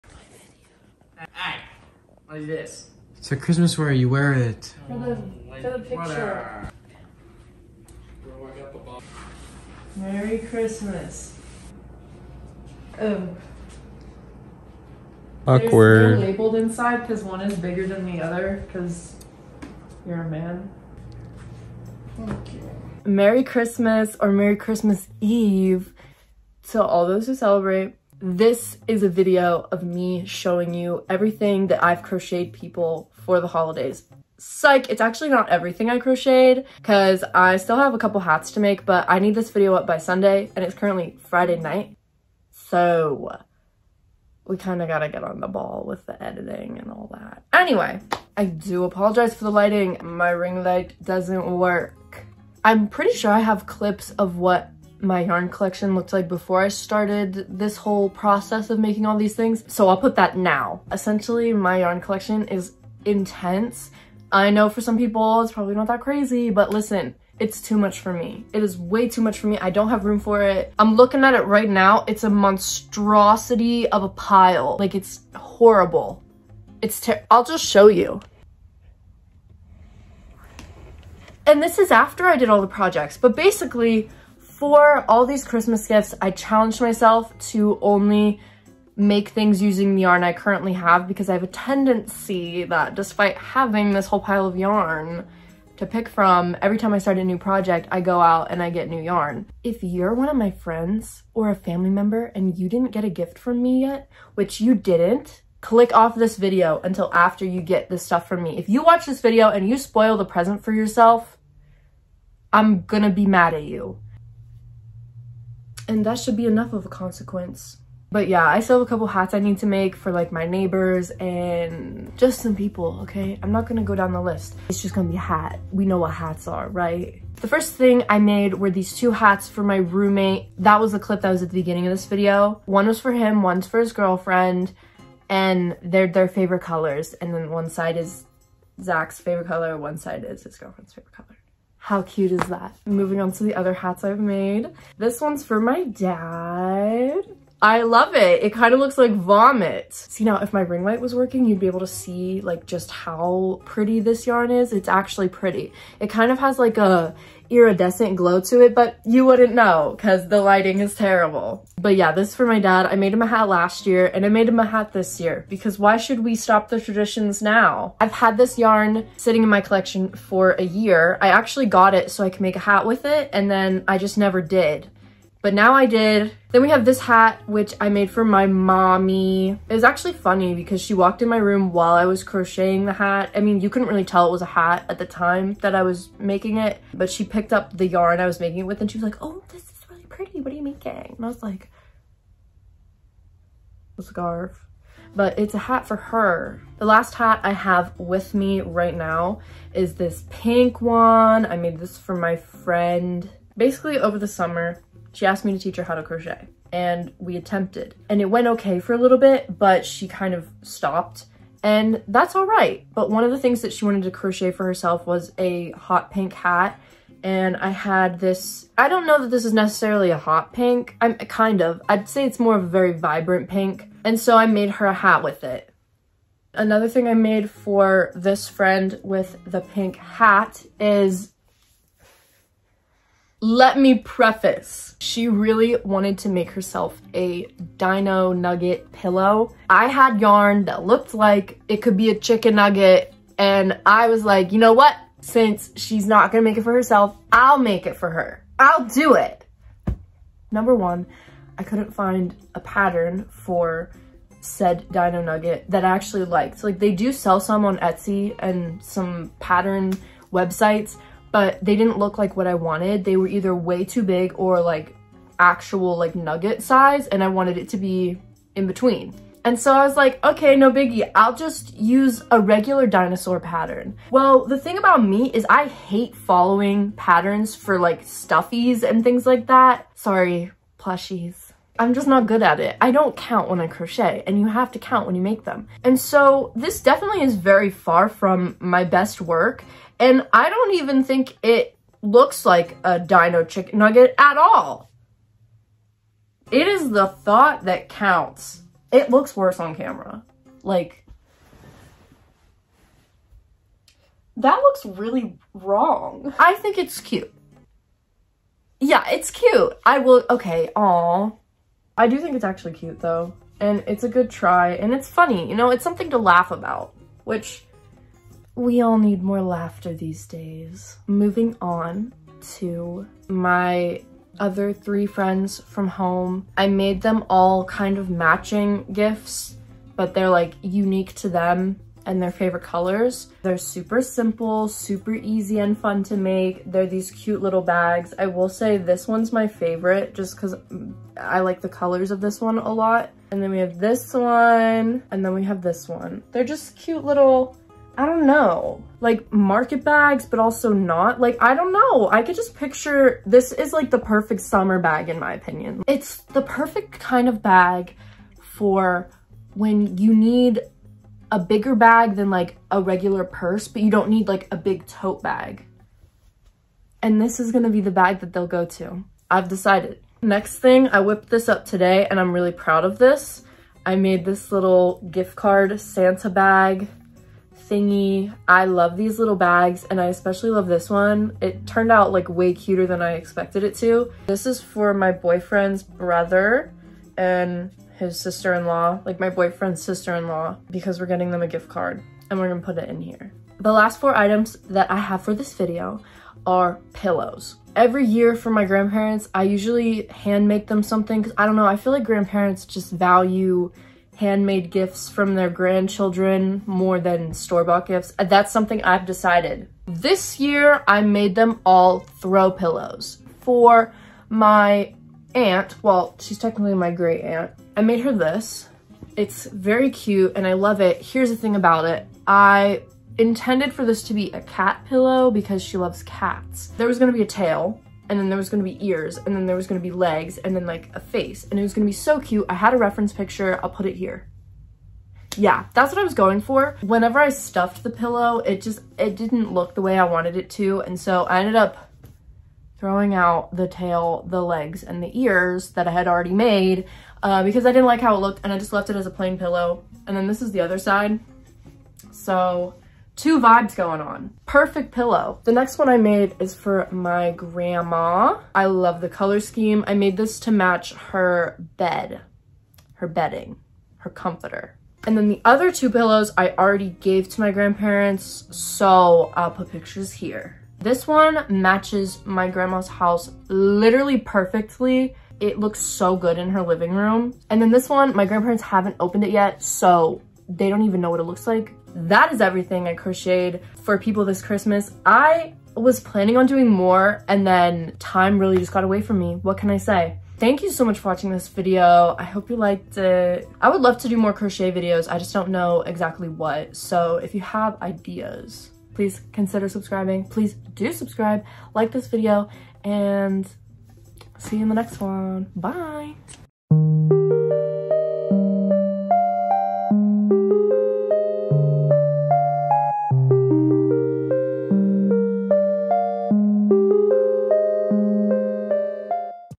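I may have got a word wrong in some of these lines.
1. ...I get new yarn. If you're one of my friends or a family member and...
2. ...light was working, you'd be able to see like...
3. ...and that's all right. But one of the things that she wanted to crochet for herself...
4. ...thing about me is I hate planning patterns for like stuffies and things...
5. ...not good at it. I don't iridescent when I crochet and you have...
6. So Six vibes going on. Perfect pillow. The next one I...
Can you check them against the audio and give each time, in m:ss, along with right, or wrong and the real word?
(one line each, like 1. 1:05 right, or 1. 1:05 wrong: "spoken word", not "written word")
1. 1:38 right
2. 2:30 right
3. 3:31 right
4. 4:34 wrong: "following", not "planning"
5. 4:42 wrong: "count", not "iridescent"
6. 7:32 wrong: "Two", not "Six".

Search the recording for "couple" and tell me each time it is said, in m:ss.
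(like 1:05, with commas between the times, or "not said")
0:37, 1:58.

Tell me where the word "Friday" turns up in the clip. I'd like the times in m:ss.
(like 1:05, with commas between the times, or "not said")
0:41.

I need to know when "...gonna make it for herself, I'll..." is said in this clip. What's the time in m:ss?
4:06.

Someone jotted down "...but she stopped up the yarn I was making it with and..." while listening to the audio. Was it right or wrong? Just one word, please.
wrong.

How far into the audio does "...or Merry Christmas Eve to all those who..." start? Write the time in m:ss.
0:24.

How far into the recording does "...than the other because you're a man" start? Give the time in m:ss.
0:17.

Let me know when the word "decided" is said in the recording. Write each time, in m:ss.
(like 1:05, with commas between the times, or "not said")
6:09, 6:49.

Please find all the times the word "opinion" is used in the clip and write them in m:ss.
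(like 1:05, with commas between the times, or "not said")
5:55.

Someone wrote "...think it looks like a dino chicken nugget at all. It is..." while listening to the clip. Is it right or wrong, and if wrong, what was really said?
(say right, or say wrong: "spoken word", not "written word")
right.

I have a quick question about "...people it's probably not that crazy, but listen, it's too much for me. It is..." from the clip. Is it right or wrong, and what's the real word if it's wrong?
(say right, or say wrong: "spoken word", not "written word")
right.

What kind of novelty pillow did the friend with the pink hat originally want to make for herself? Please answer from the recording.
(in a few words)
Dino nugget pillow.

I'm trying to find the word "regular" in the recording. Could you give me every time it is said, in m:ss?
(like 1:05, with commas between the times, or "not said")
4:32, 6:02.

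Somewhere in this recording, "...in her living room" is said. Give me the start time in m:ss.
7:56.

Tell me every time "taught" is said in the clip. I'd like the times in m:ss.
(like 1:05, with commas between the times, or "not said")
not said.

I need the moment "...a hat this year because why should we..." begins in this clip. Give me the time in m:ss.
2:44.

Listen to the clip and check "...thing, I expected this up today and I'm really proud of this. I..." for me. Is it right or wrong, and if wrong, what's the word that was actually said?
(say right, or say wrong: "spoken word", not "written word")
wrong: "whipped", not "expected".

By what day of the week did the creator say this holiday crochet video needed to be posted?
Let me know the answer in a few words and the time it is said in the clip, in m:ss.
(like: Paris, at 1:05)
Sunday, at 0:39.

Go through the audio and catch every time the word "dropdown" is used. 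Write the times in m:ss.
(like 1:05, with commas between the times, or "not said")
not said.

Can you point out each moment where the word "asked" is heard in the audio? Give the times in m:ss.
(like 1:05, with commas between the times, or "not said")
3:25.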